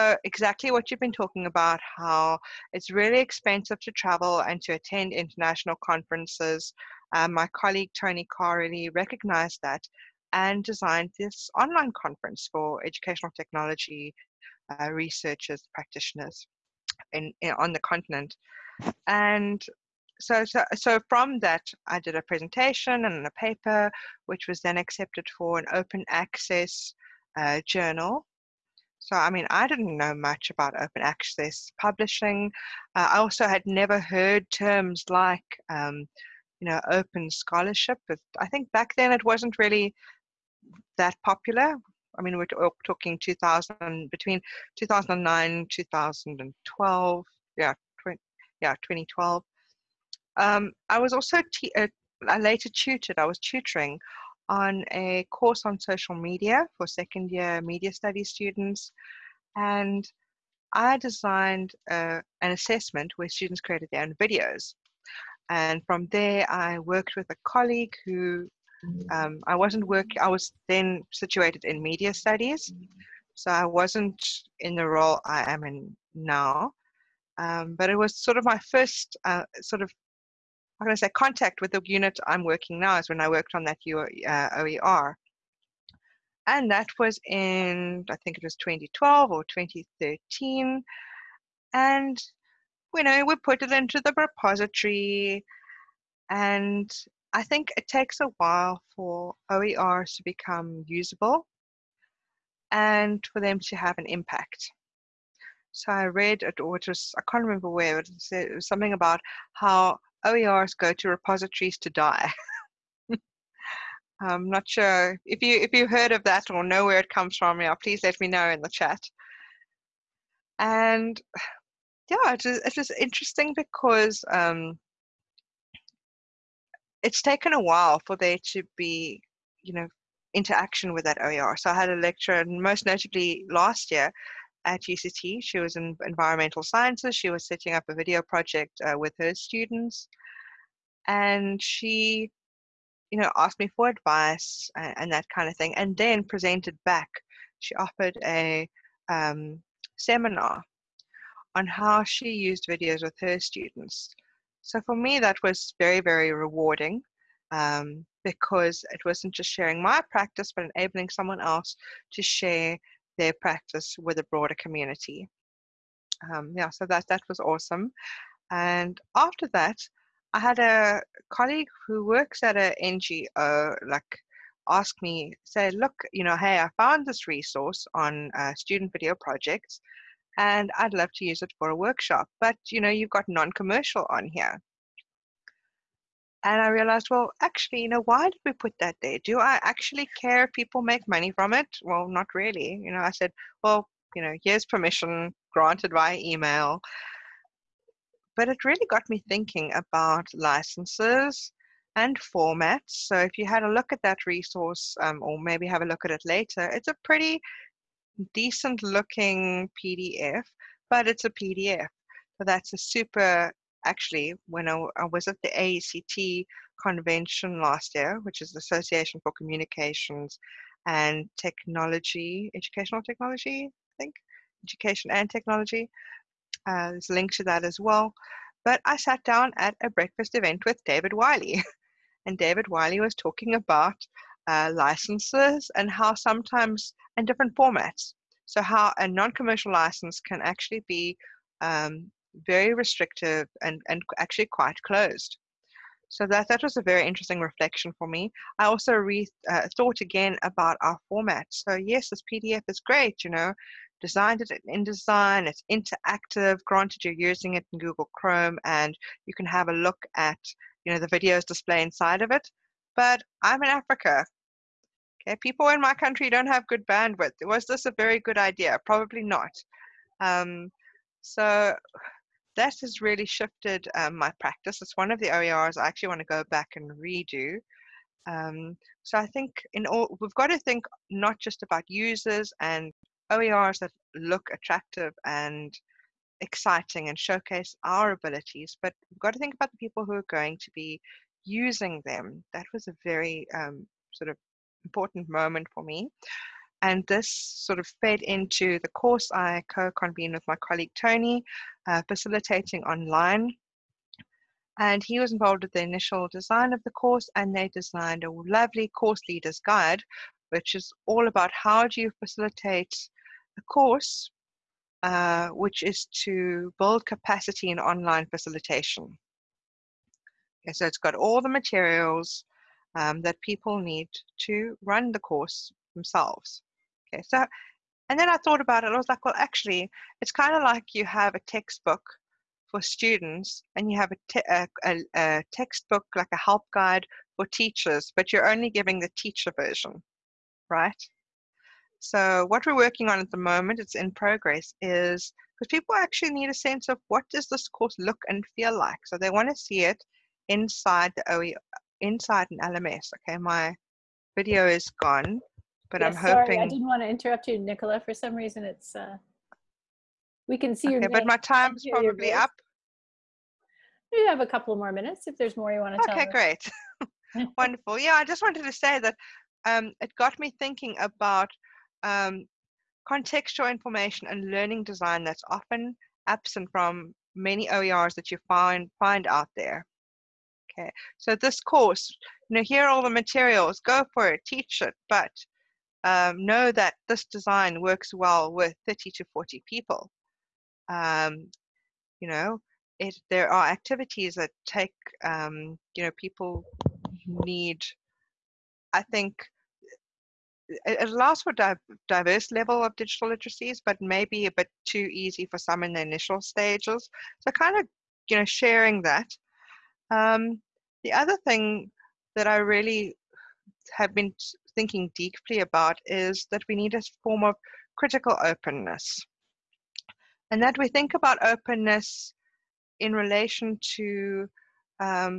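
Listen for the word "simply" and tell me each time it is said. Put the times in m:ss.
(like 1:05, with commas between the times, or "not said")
not said.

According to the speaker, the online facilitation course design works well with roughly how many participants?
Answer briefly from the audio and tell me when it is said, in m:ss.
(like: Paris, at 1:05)
30 to 40, at 6:28.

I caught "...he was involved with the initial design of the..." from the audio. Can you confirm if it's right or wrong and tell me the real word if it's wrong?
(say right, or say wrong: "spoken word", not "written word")
right.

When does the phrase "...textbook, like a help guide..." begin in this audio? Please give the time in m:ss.
5:35.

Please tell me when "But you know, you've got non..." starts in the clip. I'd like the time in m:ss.
3:02.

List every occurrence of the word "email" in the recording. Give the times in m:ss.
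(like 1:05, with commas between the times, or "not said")
3:16.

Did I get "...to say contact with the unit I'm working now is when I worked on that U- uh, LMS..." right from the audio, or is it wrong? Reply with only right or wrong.
wrong.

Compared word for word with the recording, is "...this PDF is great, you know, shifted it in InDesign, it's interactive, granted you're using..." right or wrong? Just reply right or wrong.
wrong.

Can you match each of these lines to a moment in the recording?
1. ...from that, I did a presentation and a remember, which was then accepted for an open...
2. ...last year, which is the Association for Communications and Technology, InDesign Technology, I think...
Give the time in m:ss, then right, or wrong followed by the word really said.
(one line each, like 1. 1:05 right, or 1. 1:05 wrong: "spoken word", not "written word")
1. 0:21 wrong: "paper", not "remember"
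2. 3:37 wrong: "Educational", not "InDesign".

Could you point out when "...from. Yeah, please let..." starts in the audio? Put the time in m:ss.
1:57.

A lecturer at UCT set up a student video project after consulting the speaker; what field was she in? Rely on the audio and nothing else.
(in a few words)
environmental sciences.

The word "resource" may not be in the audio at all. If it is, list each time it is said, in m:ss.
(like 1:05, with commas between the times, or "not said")
2:57, 3:24.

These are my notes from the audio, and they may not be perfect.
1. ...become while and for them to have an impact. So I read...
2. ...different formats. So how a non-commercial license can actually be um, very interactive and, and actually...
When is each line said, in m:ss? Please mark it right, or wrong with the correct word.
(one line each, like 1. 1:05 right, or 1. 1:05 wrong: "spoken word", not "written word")
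1. 1:40 wrong: "usable", not "while"
2. 3:57 wrong: "restrictive", not "interactive".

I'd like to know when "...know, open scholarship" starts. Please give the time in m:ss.
0:36.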